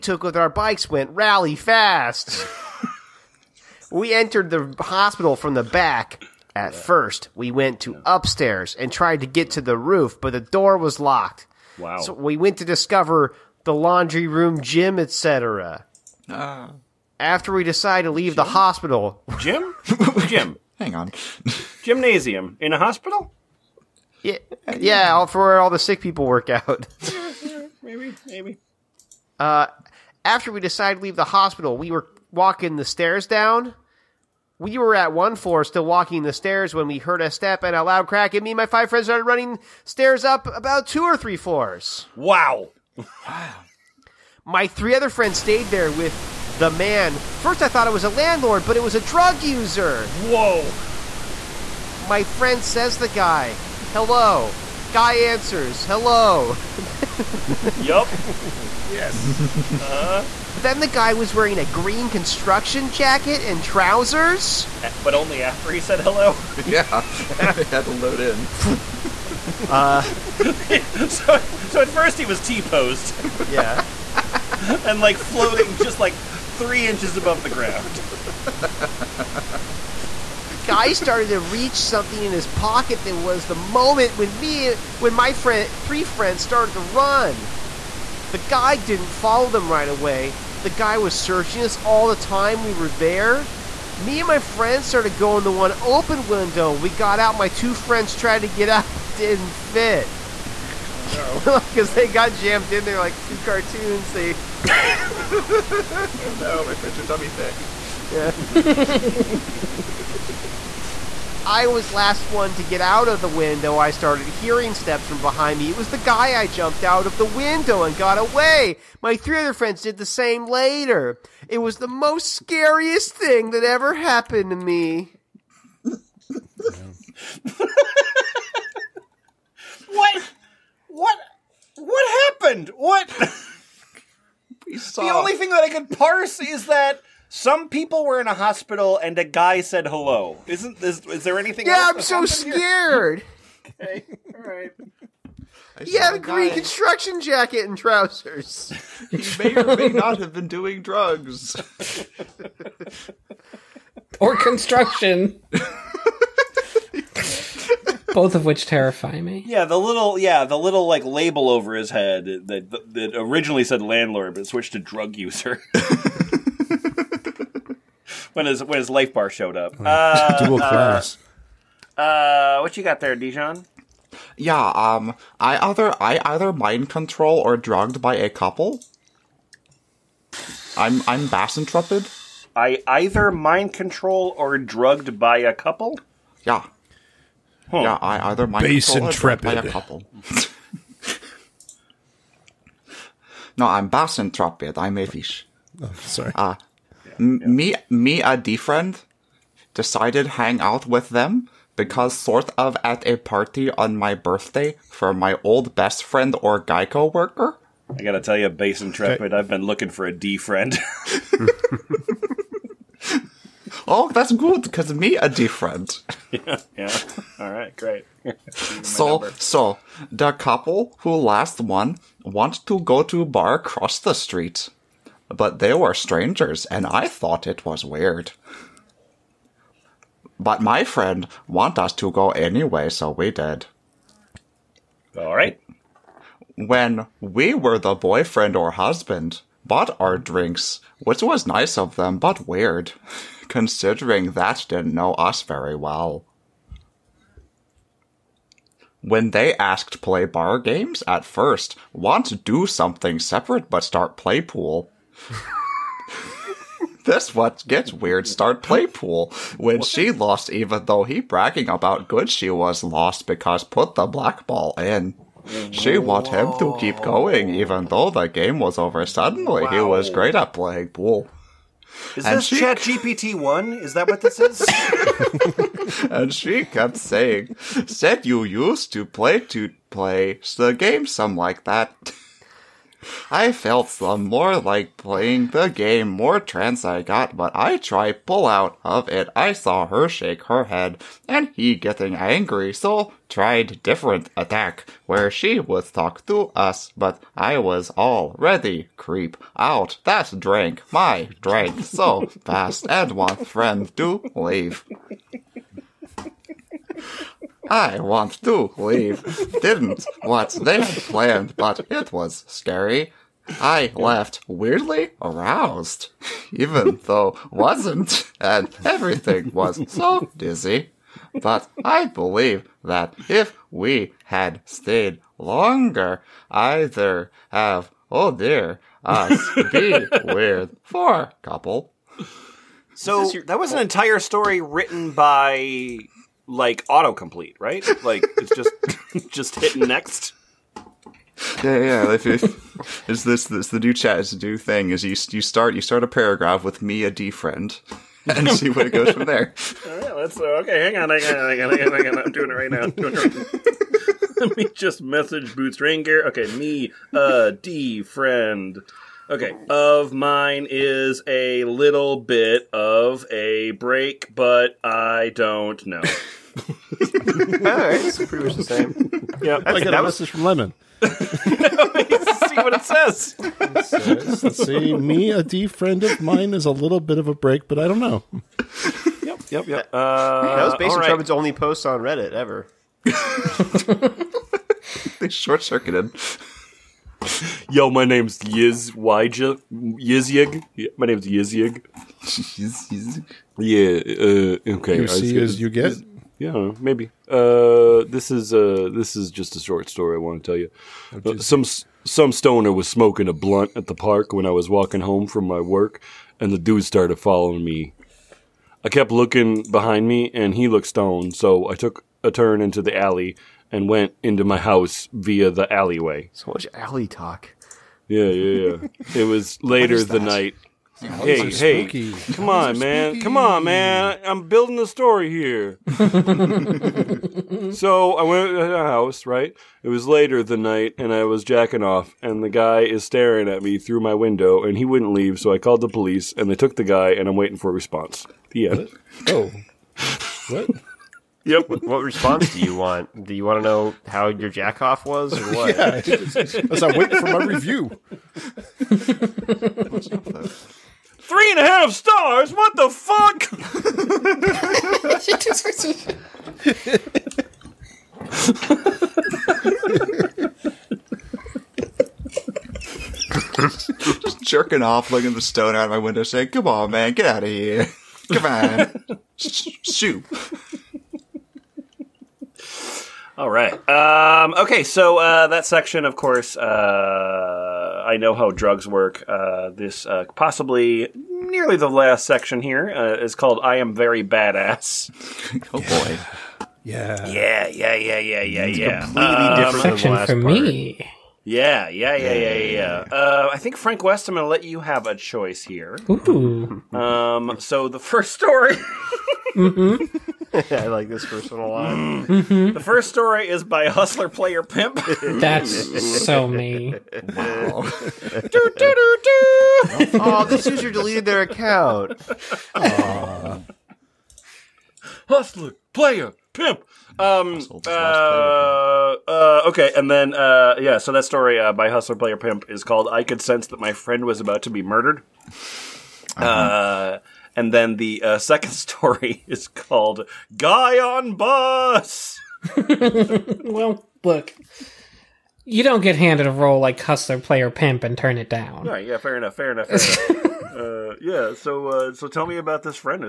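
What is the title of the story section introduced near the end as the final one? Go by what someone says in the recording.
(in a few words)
I Am Very Badass.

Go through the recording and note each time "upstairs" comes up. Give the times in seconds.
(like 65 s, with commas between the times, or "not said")
8 s.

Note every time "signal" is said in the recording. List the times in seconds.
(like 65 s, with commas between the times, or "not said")
not said.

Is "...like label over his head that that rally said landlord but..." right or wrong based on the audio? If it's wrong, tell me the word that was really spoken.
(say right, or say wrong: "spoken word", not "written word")
wrong: "originally", not "rally".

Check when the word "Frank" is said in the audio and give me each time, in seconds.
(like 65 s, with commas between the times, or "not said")
493 s.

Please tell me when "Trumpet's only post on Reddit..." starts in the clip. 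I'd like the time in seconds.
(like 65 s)
381 s.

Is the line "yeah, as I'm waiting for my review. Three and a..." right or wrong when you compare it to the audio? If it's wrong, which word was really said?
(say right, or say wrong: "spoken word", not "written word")
right.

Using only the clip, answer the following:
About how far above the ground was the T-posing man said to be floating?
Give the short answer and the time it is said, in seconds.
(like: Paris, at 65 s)
3 inches, at 76 s.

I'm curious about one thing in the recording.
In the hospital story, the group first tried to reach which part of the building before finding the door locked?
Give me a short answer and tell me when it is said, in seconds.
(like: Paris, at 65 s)
The roof, at 9 s.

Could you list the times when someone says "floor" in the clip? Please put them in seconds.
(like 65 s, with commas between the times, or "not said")
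35 s, 41 s.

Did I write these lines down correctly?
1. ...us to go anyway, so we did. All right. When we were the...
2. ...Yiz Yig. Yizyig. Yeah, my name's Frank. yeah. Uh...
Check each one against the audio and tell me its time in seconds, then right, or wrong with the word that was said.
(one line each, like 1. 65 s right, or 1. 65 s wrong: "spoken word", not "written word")
1. 231 s right
2. 388 s wrong: "Yizyig", not "Frank".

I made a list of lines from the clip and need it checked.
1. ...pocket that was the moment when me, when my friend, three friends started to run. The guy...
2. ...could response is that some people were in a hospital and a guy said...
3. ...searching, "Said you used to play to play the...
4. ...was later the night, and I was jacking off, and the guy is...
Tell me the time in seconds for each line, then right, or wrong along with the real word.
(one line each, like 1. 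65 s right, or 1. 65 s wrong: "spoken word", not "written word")
1. 82 s right
2. 135 s wrong: "parse", not "response"
3. 276 s wrong: "saying", not "searching"
4. 429 s right.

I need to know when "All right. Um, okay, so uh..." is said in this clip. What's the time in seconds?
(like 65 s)
473 s.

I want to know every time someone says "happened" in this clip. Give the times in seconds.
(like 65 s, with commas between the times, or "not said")
123 s, 132 s.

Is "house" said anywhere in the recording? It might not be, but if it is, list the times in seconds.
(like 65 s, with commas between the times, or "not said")
414 s, 428 s.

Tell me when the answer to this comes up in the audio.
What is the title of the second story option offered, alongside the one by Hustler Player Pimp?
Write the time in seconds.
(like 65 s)
530 s.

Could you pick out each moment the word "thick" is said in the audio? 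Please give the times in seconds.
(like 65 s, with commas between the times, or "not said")
107 s.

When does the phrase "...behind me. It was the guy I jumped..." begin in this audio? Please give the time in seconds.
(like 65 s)
115 s.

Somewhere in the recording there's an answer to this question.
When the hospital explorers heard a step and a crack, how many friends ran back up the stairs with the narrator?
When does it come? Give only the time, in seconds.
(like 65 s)
38 s.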